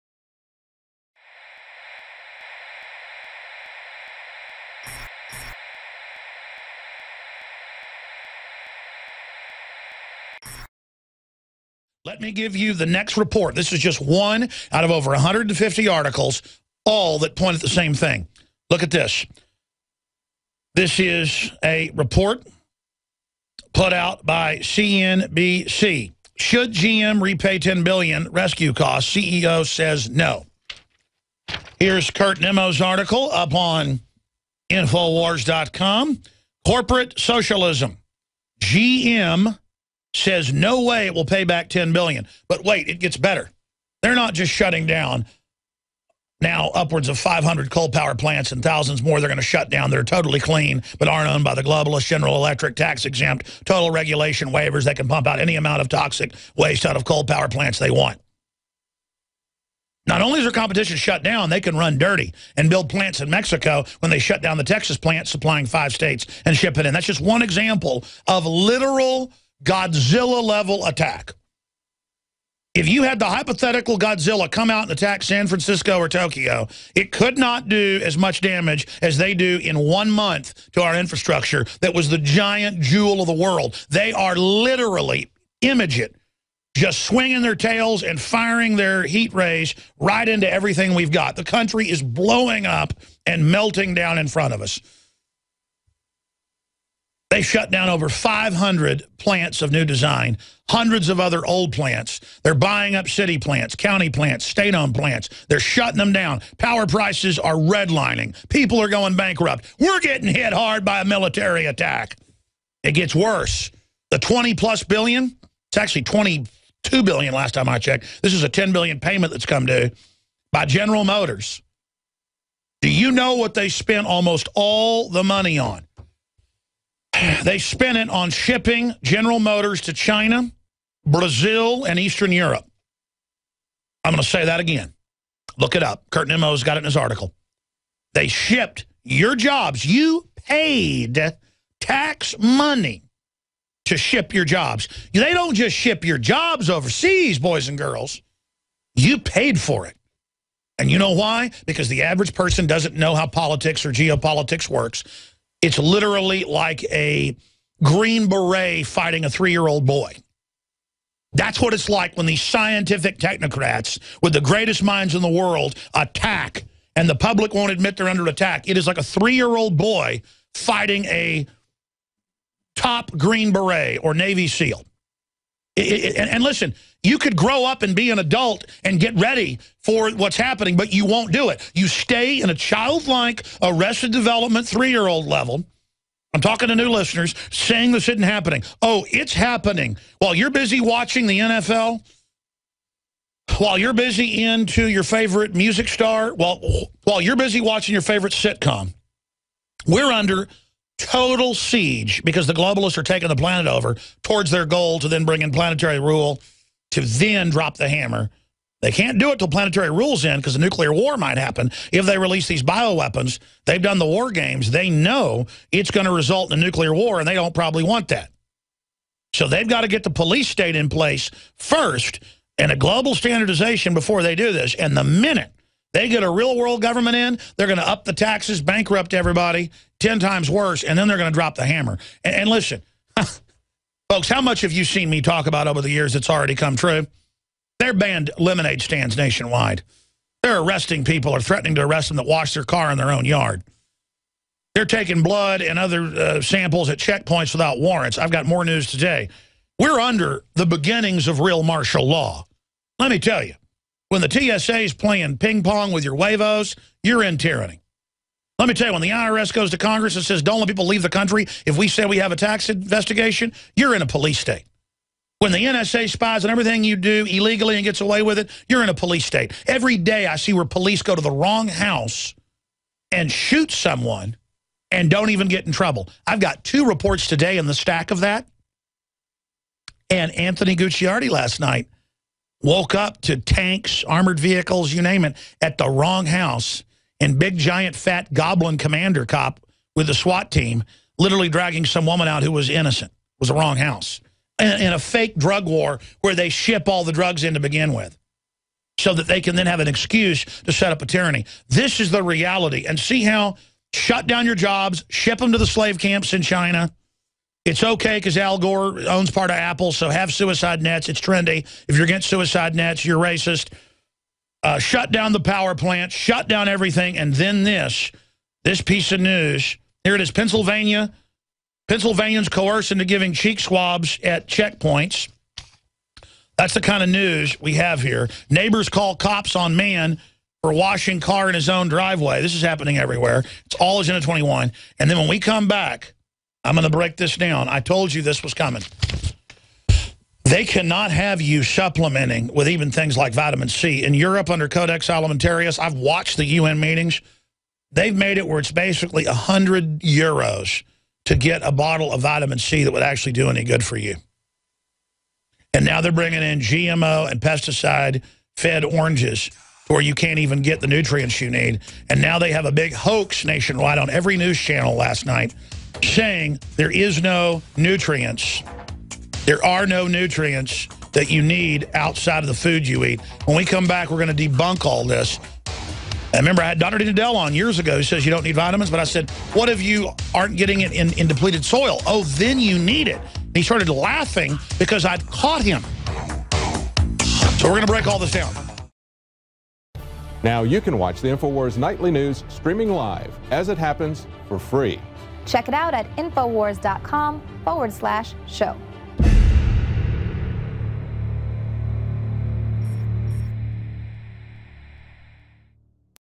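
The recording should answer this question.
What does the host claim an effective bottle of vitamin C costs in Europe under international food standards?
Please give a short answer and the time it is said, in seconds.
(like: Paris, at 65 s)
100 euros, at 349 s.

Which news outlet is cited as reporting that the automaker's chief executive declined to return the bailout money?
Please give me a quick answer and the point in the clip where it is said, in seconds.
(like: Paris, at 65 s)
CNBC, at 24 s.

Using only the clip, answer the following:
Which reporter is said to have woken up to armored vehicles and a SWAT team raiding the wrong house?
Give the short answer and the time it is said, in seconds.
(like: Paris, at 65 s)
Anthony Gucciardi, at 280 s.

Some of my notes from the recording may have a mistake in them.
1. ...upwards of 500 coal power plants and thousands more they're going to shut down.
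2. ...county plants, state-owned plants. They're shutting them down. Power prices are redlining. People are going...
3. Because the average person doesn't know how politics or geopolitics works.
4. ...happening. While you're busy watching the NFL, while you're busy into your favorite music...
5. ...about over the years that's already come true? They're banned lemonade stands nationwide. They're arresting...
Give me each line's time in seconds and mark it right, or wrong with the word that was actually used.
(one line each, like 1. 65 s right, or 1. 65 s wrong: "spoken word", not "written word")
1. 46 s right
2. 103 s right
3. 151 s right
4. 189 s right
5. 235 s right.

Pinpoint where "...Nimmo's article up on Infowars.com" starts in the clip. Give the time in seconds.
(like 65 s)
32 s.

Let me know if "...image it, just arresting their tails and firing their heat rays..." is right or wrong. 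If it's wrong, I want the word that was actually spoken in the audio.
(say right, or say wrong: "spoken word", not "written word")
wrong: "swinging", not "arresting".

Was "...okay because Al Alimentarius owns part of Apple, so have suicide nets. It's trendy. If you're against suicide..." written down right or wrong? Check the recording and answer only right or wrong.
wrong.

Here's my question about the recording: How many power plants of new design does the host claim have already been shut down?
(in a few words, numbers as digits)
500.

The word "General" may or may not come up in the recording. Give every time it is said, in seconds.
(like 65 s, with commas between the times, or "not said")
52 s, 120 s, 129 s.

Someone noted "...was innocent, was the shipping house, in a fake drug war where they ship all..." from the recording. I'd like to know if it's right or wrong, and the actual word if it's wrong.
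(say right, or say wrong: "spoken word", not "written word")
wrong: "wrong", not "shipping".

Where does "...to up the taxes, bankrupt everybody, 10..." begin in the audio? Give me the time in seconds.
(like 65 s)
227 s.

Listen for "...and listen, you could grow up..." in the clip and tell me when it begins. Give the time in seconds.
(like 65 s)
176 s.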